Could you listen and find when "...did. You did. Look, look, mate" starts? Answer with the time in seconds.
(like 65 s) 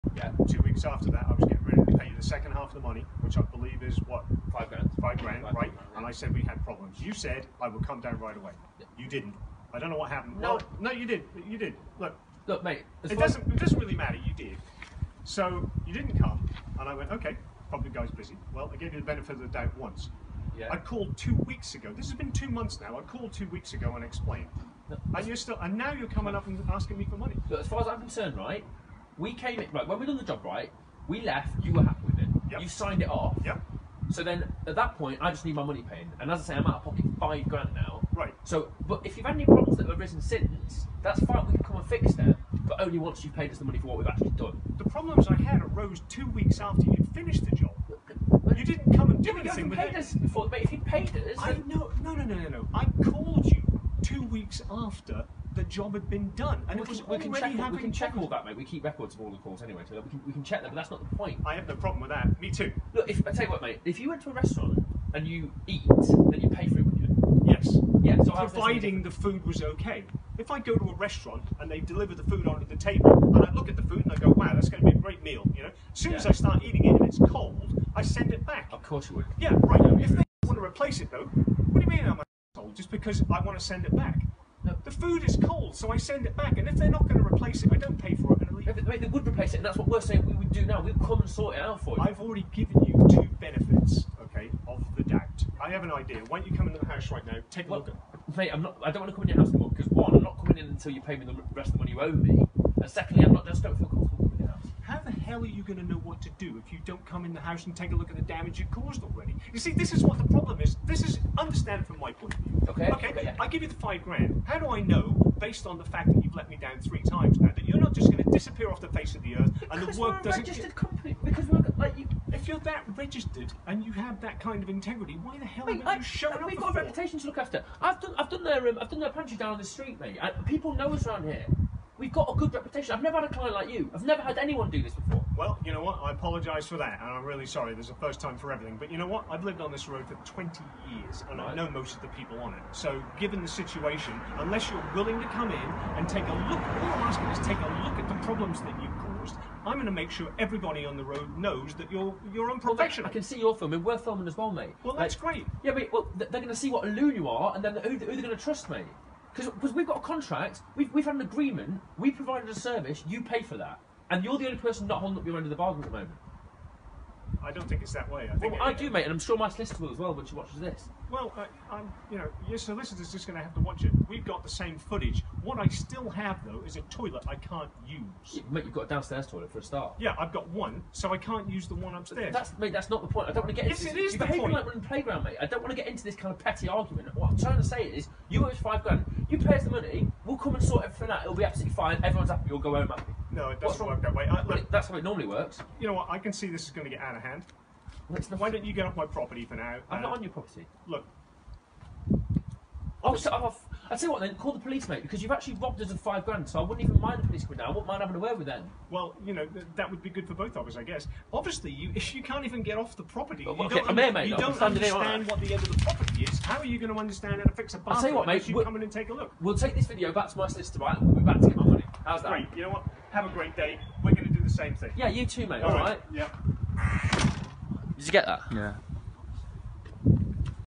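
11 s.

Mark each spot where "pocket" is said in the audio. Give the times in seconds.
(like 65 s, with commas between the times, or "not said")
36 s.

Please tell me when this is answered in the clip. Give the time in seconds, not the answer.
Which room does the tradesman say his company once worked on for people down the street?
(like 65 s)
129 s.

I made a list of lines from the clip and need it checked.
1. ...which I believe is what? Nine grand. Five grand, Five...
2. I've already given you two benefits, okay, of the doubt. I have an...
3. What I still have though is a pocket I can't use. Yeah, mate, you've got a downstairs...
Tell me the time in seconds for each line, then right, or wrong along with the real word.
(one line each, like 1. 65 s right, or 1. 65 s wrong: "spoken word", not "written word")
1. 3 s wrong: "Five", not "Nine"
2. 92 s right
3. 175 s wrong: "toilet", not "pocket".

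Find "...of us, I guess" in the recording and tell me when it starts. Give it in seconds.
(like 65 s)
210 s.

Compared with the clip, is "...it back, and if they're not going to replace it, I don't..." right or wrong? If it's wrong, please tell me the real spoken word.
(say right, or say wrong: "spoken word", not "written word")
right.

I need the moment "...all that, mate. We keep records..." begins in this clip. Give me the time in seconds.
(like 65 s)
58 s.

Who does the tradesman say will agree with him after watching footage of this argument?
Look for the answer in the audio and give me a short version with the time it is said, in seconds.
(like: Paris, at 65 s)
my solicitor, at 169 s.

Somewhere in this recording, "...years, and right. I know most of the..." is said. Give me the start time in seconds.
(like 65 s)
140 s.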